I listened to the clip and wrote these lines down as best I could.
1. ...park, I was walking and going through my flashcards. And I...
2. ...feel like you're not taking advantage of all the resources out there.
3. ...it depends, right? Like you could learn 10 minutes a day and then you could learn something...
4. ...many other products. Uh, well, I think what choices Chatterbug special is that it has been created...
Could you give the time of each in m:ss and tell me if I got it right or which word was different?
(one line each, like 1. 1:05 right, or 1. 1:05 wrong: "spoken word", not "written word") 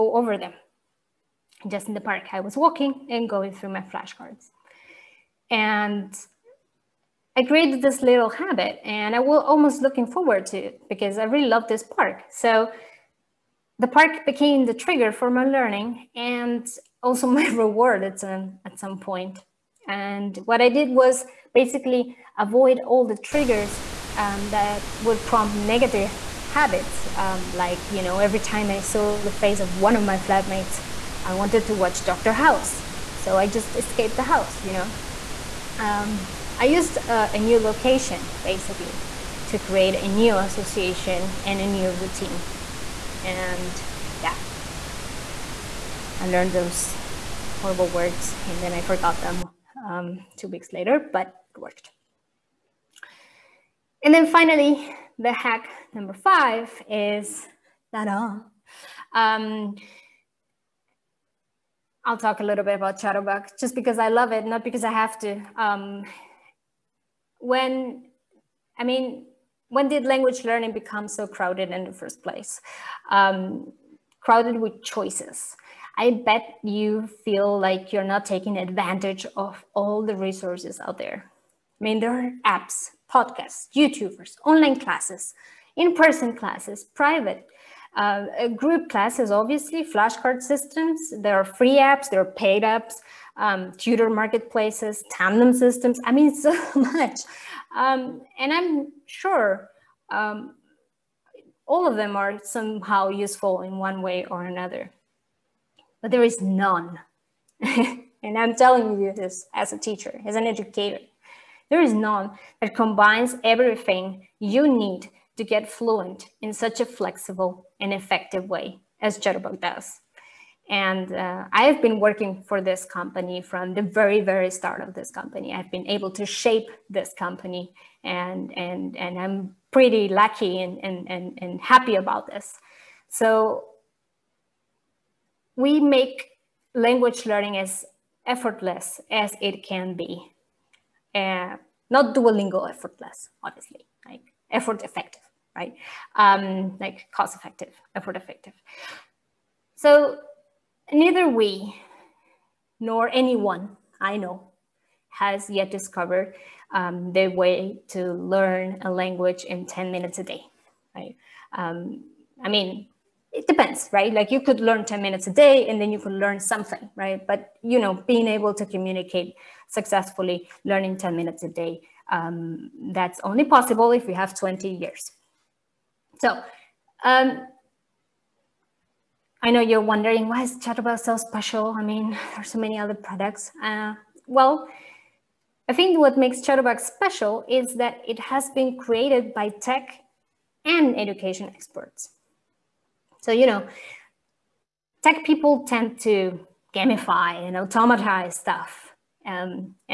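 1. 0:02 right
2. 1:17 right
3. 2:43 right
4. 3:02 wrong: "makes", not "choices".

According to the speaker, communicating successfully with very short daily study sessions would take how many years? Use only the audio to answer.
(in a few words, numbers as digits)
20.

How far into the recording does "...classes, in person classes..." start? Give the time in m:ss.
1:24.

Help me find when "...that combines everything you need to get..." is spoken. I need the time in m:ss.
1:52.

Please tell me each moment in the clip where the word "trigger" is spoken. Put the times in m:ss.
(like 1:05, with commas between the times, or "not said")
0:14, 0:23.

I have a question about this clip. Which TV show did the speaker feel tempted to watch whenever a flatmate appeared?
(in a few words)
Dr. House.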